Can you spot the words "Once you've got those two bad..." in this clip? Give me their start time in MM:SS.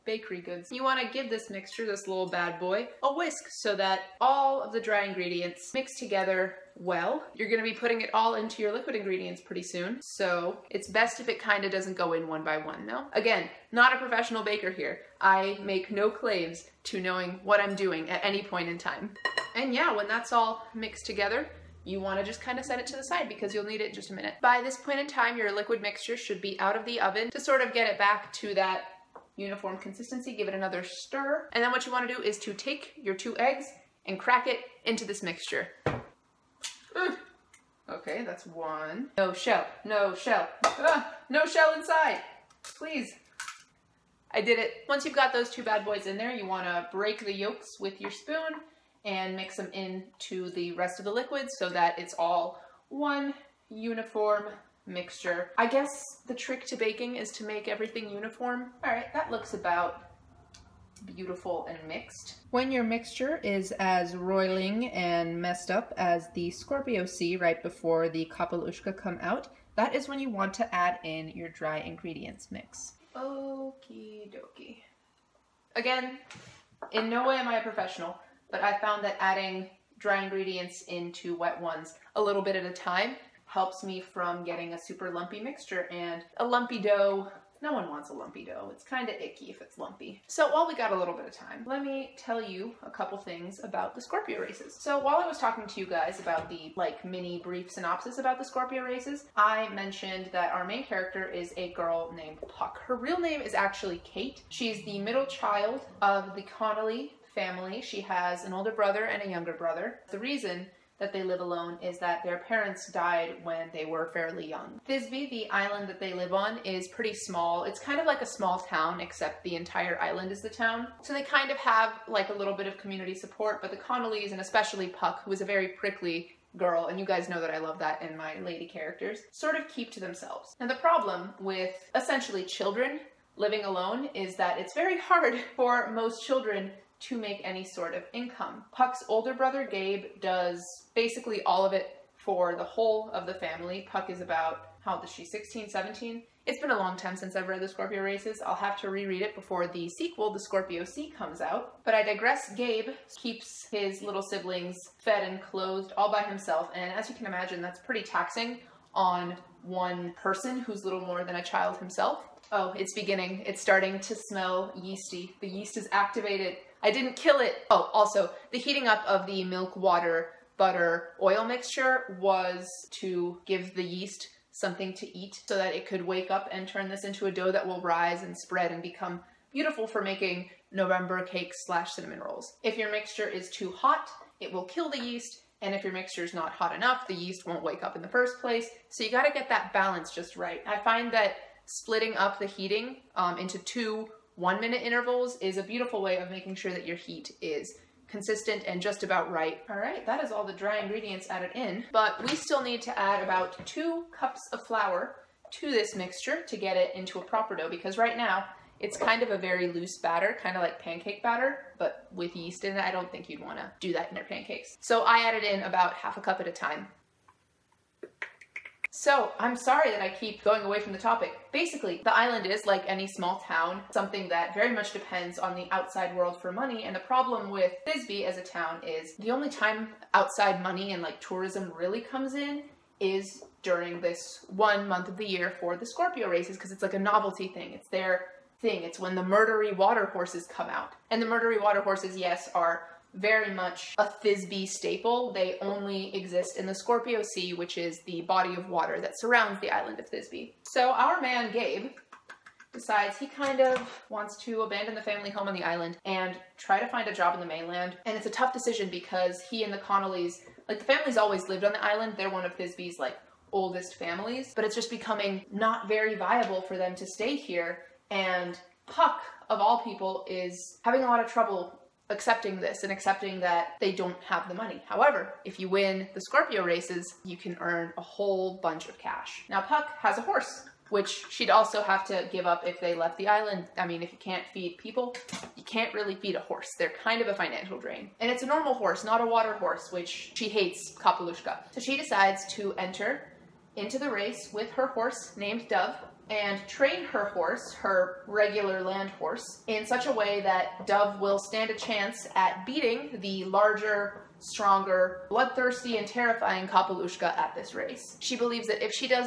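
00:44.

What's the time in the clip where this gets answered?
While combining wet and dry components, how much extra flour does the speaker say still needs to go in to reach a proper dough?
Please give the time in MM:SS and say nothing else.
03:23.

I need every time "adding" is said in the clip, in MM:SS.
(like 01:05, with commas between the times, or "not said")
01:19.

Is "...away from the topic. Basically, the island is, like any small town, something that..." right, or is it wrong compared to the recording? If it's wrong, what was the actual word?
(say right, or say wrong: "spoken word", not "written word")
right.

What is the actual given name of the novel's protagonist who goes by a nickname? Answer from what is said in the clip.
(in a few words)
Kate.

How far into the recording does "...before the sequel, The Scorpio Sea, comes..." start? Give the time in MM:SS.
02:29.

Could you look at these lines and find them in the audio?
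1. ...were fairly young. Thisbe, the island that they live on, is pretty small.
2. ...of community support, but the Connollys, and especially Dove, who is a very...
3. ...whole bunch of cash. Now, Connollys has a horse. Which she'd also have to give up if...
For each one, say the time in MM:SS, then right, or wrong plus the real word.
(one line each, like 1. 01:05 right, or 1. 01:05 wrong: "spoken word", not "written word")
1. 01:53 right
2. 02:02 wrong: "Puck", not "Dove"
3. 04:38 wrong: "Puck", not "Connollys".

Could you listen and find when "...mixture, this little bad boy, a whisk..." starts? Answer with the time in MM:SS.
00:01.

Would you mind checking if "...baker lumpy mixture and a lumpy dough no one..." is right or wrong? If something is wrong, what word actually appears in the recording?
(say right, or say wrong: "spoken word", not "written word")
wrong: "super", not "baker".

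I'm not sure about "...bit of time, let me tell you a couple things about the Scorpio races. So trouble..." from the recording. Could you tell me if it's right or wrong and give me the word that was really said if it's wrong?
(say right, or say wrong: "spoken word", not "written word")
wrong: "while", not "trouble".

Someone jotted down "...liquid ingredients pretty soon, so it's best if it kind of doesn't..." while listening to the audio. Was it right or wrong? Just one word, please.
right.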